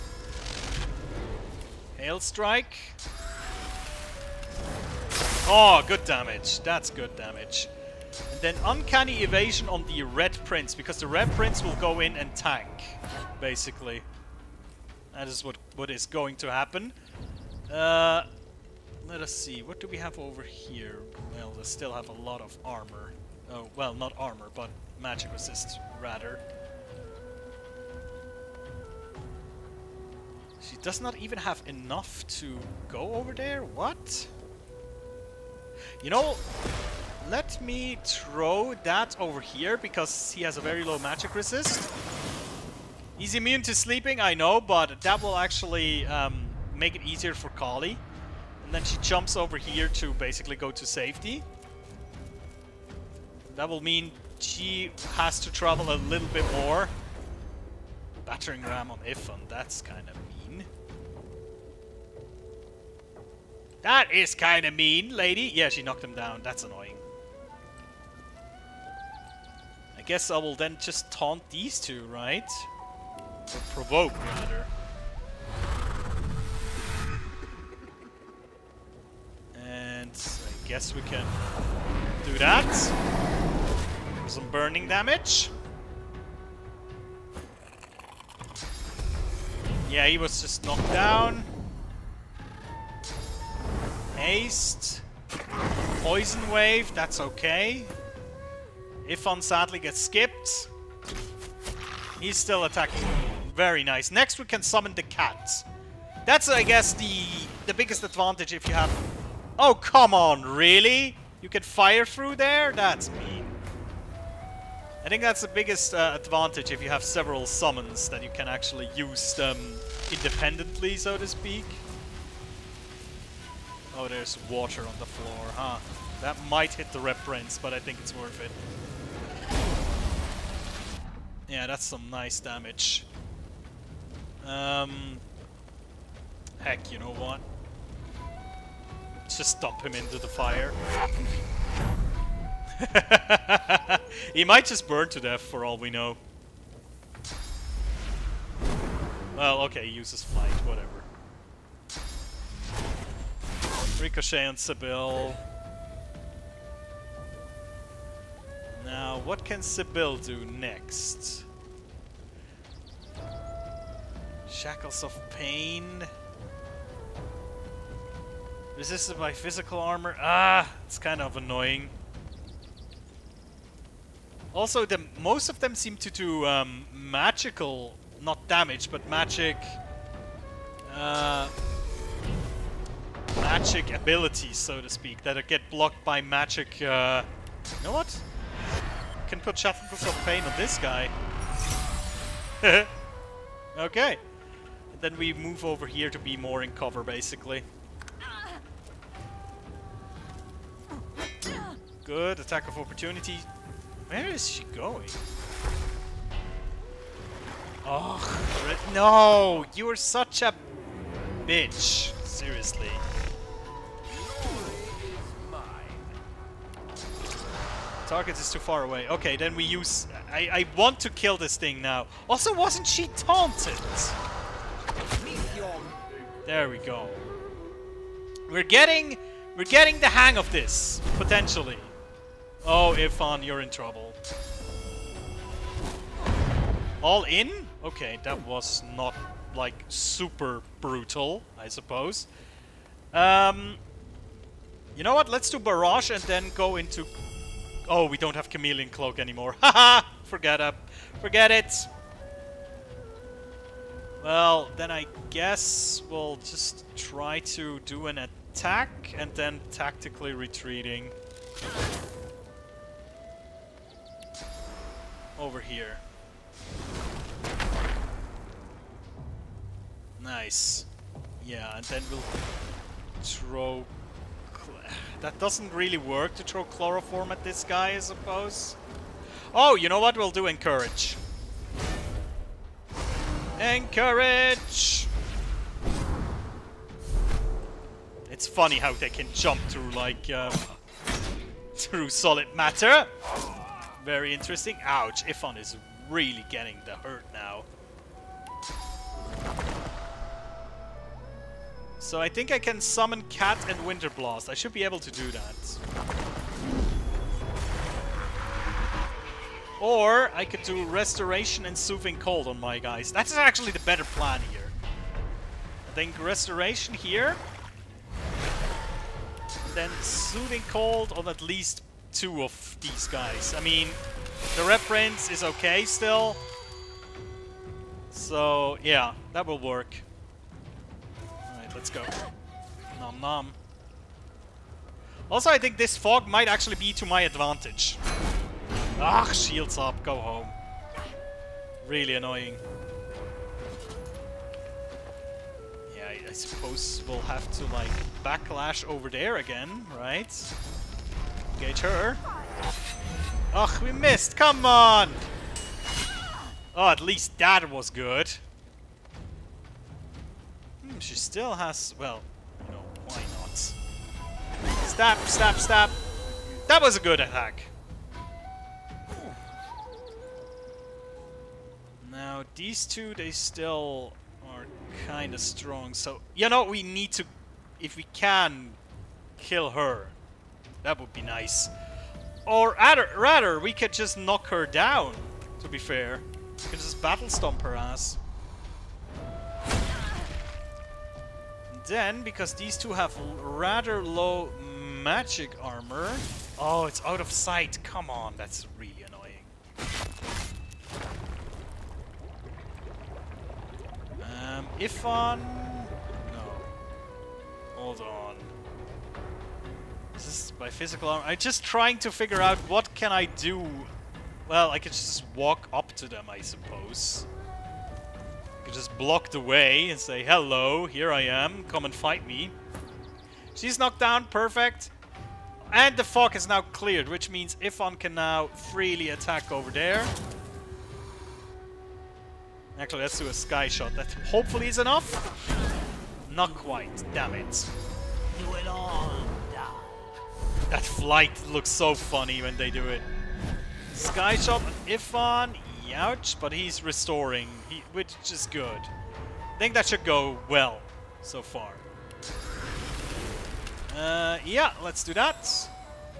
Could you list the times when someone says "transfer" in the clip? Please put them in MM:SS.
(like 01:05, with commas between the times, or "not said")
not said.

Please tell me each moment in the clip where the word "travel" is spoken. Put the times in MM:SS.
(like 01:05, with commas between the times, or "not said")
00:55.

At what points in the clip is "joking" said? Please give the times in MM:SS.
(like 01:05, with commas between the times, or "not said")
not said.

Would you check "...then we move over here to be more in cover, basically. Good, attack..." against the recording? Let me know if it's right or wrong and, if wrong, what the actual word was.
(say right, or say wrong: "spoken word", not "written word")
right.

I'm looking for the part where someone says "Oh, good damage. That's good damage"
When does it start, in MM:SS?
00:05.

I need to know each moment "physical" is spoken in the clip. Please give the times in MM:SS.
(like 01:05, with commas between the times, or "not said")
02:49, 06:50.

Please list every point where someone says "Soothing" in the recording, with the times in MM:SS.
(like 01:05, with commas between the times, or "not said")
05:11, 05:20.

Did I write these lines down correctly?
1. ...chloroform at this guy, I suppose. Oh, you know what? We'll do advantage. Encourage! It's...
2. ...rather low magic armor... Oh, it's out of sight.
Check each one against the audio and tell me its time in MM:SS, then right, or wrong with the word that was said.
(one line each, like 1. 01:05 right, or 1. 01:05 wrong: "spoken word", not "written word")
1. 04:36 wrong: "encourage", not "advantage"
2. 06:33 right.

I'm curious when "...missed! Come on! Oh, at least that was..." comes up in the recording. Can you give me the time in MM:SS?
05:53.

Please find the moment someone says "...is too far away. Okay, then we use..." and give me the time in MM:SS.
03:38.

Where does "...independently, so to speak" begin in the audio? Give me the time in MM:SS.
02:00.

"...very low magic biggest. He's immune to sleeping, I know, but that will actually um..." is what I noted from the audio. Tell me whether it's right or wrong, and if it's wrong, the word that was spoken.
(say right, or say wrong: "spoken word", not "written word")
wrong: "resist", not "biggest".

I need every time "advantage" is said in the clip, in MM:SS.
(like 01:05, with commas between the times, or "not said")
01:48, 01:56, 05:37.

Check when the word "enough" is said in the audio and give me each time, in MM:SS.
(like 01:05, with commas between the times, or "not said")
00:31, 07:14.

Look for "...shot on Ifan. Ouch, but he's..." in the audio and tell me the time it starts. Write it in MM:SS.
07:24.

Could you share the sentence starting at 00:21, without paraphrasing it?
Well, they still have a lot of armor.